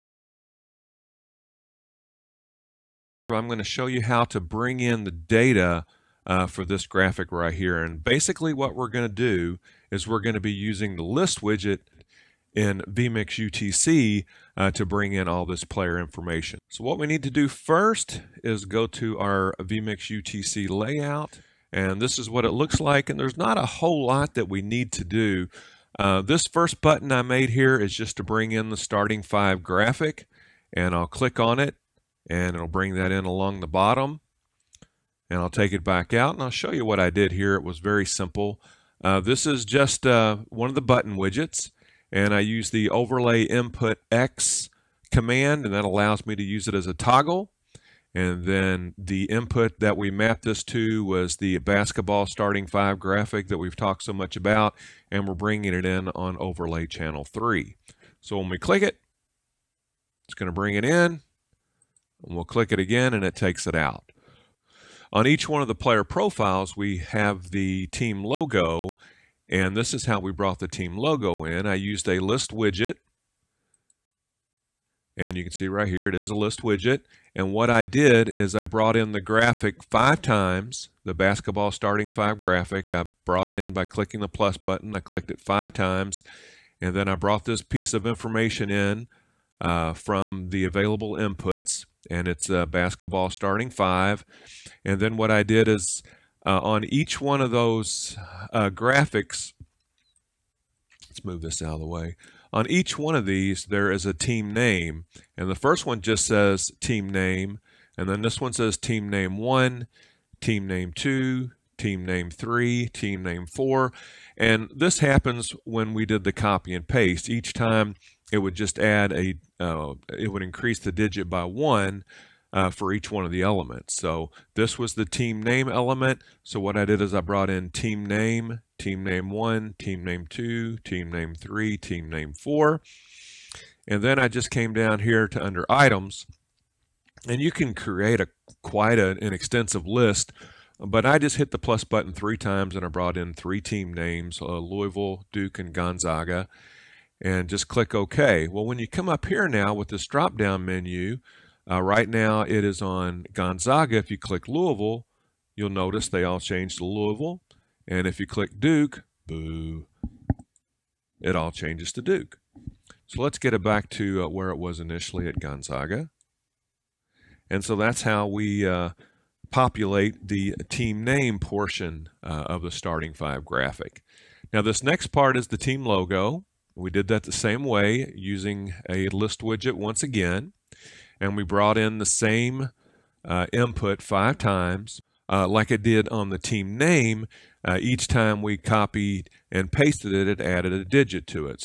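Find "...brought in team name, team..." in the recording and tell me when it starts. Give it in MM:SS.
02:07.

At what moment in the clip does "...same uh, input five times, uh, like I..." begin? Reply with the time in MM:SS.
03:02.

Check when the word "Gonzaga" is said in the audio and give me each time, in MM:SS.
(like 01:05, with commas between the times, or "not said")
02:25, 02:33, 02:45.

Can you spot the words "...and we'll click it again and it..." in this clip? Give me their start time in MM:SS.
01:02.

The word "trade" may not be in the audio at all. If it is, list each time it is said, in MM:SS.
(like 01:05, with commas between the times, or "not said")
not said.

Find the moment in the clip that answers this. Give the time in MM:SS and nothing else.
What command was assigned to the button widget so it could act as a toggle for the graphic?
00:42.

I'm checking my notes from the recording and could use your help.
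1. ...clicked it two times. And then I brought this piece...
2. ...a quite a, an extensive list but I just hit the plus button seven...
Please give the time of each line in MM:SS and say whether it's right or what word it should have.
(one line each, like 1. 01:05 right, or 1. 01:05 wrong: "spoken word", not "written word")
1. 01:24 wrong: "five", not "two"
2. 02:18 wrong: "three", not "seven".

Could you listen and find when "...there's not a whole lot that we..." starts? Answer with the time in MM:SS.
00:23.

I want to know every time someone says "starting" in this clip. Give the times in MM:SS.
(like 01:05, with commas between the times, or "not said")
00:28, 00:52, 01:21, 01:33, 02:52.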